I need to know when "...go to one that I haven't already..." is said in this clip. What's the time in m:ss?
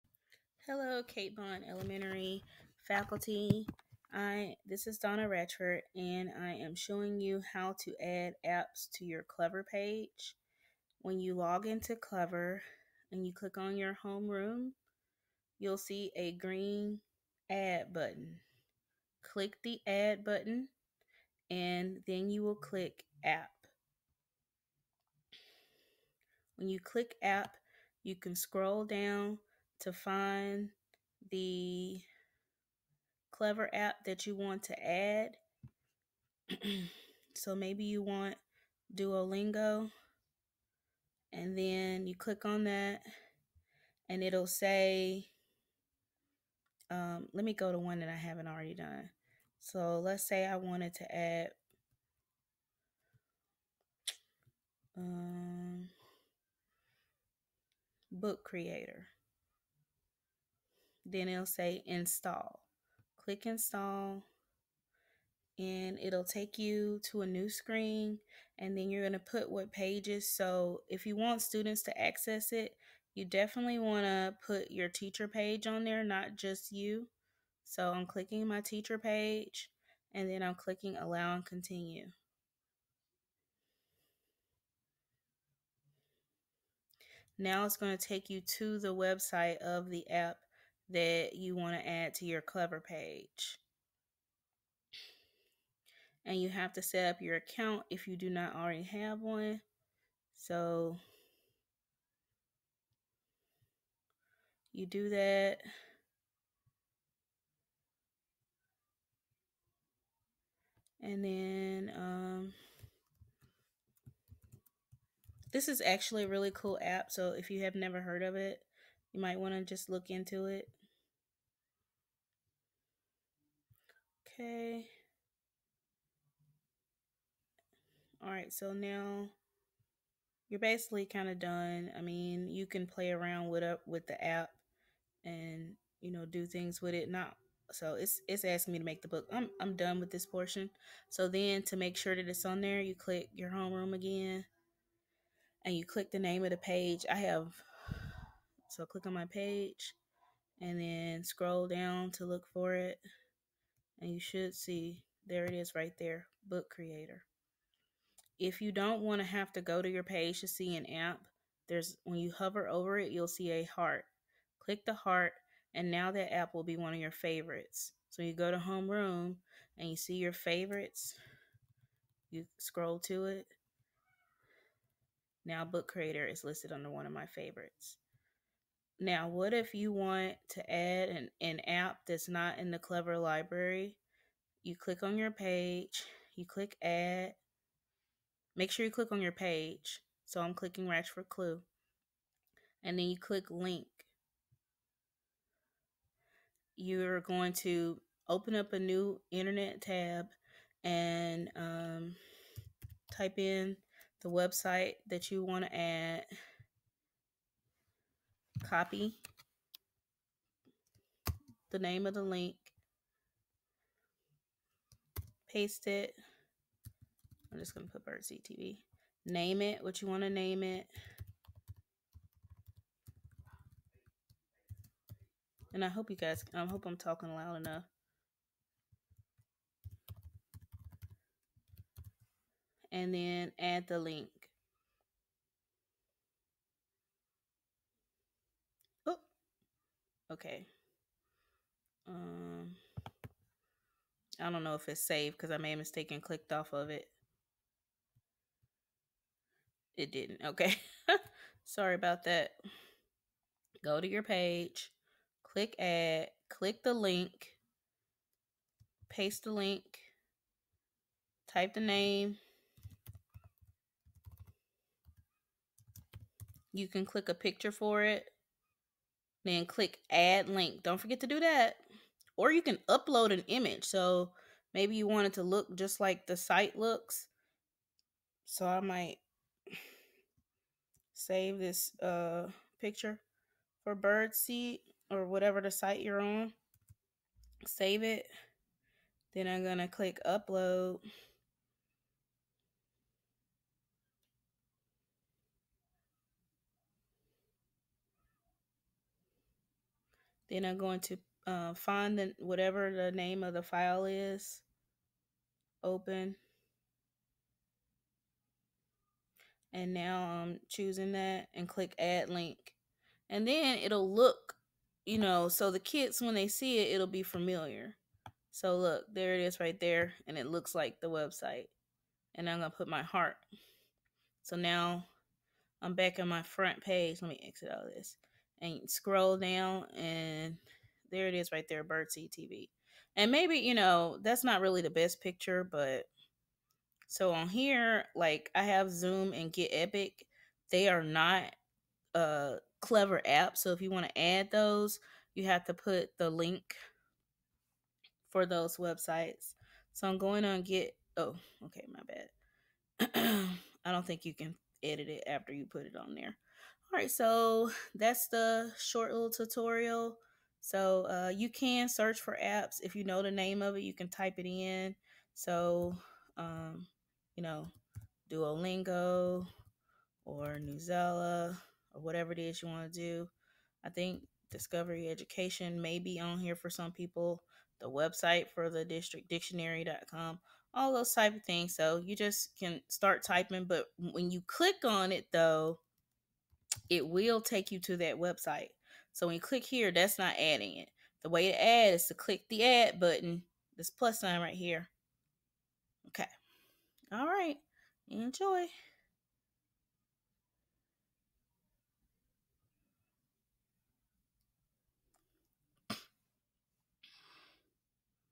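0:47.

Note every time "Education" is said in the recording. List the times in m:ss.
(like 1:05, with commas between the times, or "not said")
6:15.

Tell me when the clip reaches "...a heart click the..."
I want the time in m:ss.
2:43.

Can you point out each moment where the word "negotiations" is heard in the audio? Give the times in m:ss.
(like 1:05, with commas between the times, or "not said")
not said.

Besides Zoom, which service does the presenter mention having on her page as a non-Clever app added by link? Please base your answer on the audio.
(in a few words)
Get Epic.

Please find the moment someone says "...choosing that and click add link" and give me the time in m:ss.
5:10.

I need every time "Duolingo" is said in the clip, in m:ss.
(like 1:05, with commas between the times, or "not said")
0:38, 6:08.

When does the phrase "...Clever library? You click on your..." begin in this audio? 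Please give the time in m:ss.
3:02.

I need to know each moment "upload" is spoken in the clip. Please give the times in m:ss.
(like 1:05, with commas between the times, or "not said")
4:32, 4:50.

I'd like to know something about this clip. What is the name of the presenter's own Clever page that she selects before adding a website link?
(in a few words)
Ratchford Clue.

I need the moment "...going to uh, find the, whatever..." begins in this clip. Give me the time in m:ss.
5:00.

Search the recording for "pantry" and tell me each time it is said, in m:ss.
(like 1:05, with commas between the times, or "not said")
not said.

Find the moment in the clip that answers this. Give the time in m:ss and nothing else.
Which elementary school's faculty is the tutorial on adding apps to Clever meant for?
0:01.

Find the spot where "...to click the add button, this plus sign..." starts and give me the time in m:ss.
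6:32.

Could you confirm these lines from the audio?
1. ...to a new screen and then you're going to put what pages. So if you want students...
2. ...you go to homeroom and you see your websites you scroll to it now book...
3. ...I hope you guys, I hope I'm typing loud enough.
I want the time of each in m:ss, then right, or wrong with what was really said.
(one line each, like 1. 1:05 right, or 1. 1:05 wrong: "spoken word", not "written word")
1. 1:07 right
2. 2:48 wrong: "favorites", not "websites"
3. 3:45 wrong: "talking", not "typing".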